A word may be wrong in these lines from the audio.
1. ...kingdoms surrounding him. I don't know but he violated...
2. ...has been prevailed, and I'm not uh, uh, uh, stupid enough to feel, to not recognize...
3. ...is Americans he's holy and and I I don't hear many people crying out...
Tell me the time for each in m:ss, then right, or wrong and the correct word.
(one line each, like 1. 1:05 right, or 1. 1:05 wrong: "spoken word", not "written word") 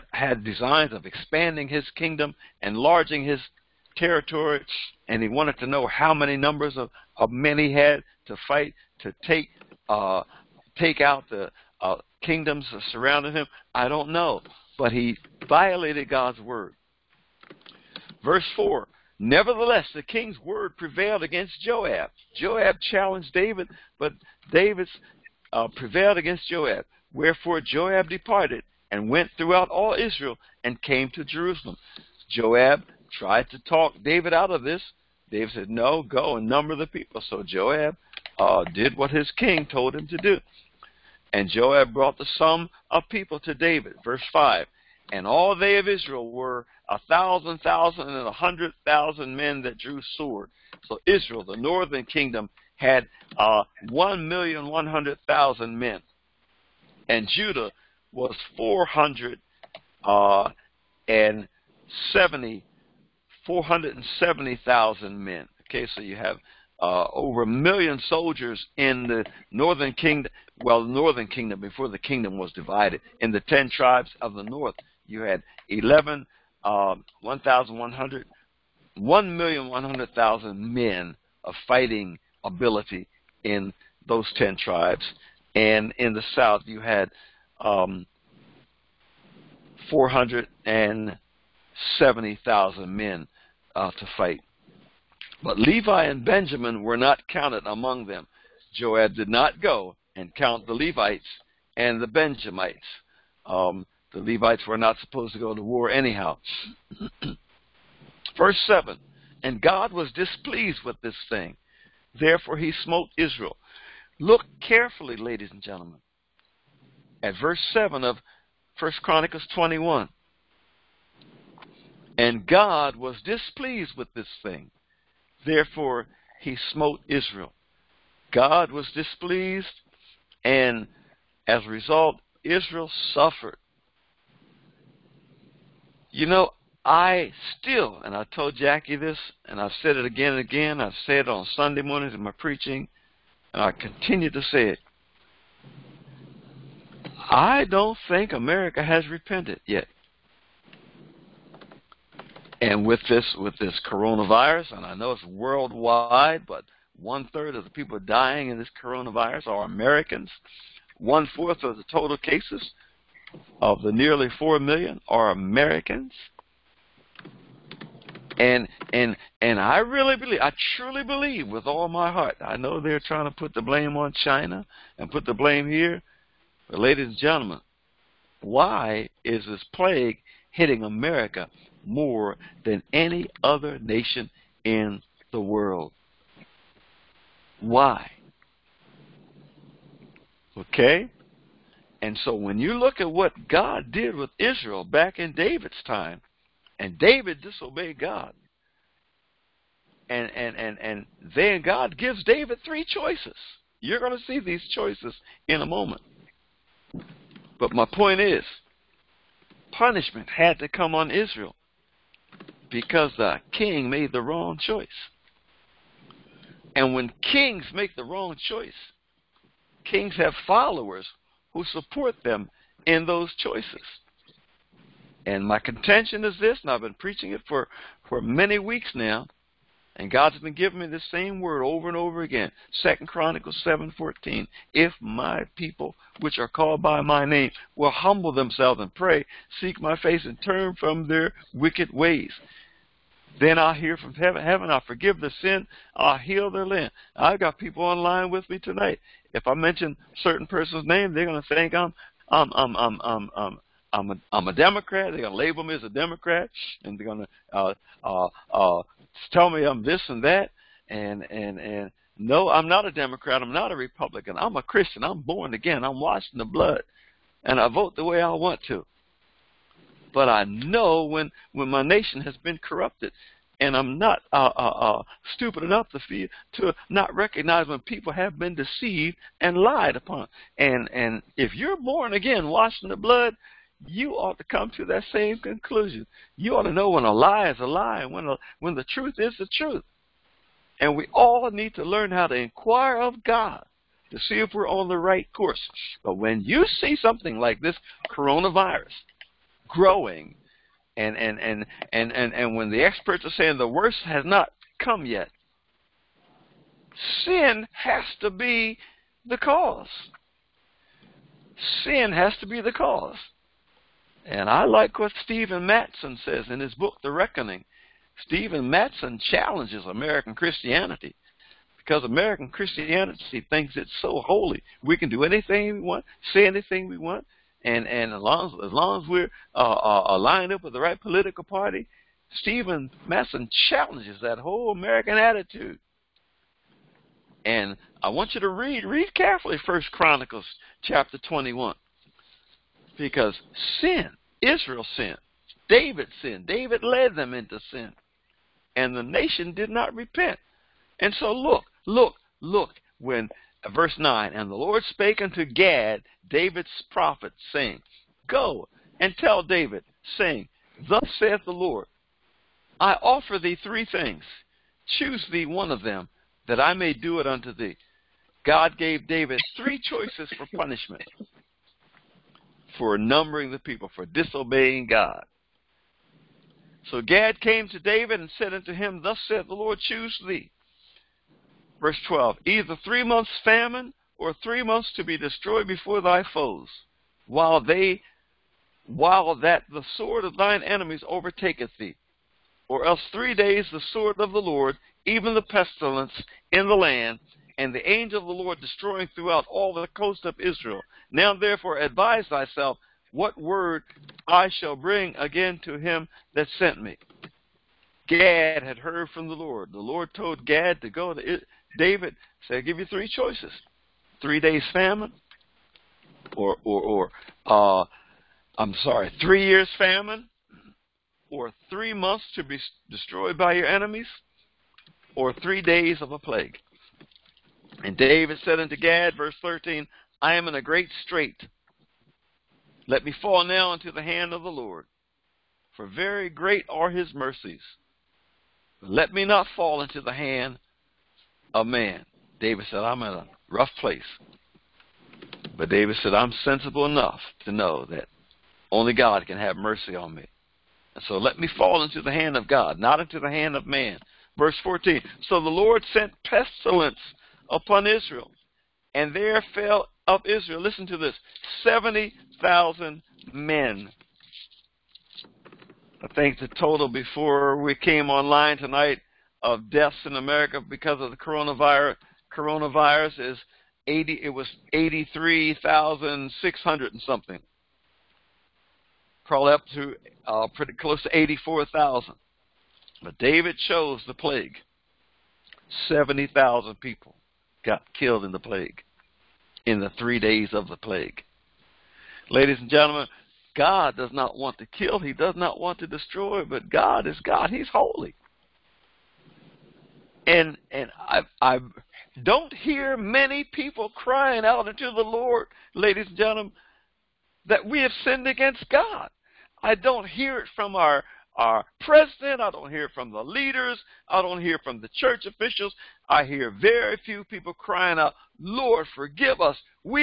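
1. 0:12 right
2. 4:32 wrong: "corrupted", not "prevailed"
3. 8:17 wrong: "God", not "Americans".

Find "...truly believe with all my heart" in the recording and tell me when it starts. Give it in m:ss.
2:50.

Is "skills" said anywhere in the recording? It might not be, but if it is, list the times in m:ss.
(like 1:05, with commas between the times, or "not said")
not said.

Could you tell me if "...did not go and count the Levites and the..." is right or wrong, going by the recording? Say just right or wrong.
right.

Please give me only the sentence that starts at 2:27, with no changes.
I don't think America has repented yet.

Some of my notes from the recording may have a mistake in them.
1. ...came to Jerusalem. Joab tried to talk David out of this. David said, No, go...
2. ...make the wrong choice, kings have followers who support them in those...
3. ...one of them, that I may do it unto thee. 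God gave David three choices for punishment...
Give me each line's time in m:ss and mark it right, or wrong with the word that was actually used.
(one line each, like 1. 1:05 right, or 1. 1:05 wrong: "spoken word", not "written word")
1. 0:30 right
2. 3:37 right
3. 6:05 right.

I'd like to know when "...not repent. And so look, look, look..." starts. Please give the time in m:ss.
5:49.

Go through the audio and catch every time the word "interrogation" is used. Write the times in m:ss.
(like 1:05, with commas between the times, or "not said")
not said.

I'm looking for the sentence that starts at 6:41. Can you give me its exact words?
Now therefore advise thyself what word I shall bring again to him that sent me.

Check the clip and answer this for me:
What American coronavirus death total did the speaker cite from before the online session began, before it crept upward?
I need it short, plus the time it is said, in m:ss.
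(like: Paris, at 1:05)
83,600, at 7:54.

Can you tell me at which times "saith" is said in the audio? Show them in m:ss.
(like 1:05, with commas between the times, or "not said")
6:01, 6:19.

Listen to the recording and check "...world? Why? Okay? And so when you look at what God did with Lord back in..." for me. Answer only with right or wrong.
wrong.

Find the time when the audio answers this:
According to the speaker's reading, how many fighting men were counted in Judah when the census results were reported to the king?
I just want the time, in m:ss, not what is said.
1:03.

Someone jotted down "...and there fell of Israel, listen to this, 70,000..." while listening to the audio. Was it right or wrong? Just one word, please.
right.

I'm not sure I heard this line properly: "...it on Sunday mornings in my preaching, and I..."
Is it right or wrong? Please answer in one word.
right.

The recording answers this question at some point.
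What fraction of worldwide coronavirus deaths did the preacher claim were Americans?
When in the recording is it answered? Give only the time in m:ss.
2:36.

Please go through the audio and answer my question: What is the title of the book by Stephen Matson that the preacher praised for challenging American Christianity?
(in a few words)
The Reckoning.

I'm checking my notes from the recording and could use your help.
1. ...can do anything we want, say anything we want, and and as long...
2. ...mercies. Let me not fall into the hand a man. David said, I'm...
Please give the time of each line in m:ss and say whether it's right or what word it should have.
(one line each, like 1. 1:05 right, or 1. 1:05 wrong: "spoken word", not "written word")
1. 5:24 right
2. 7:17 right.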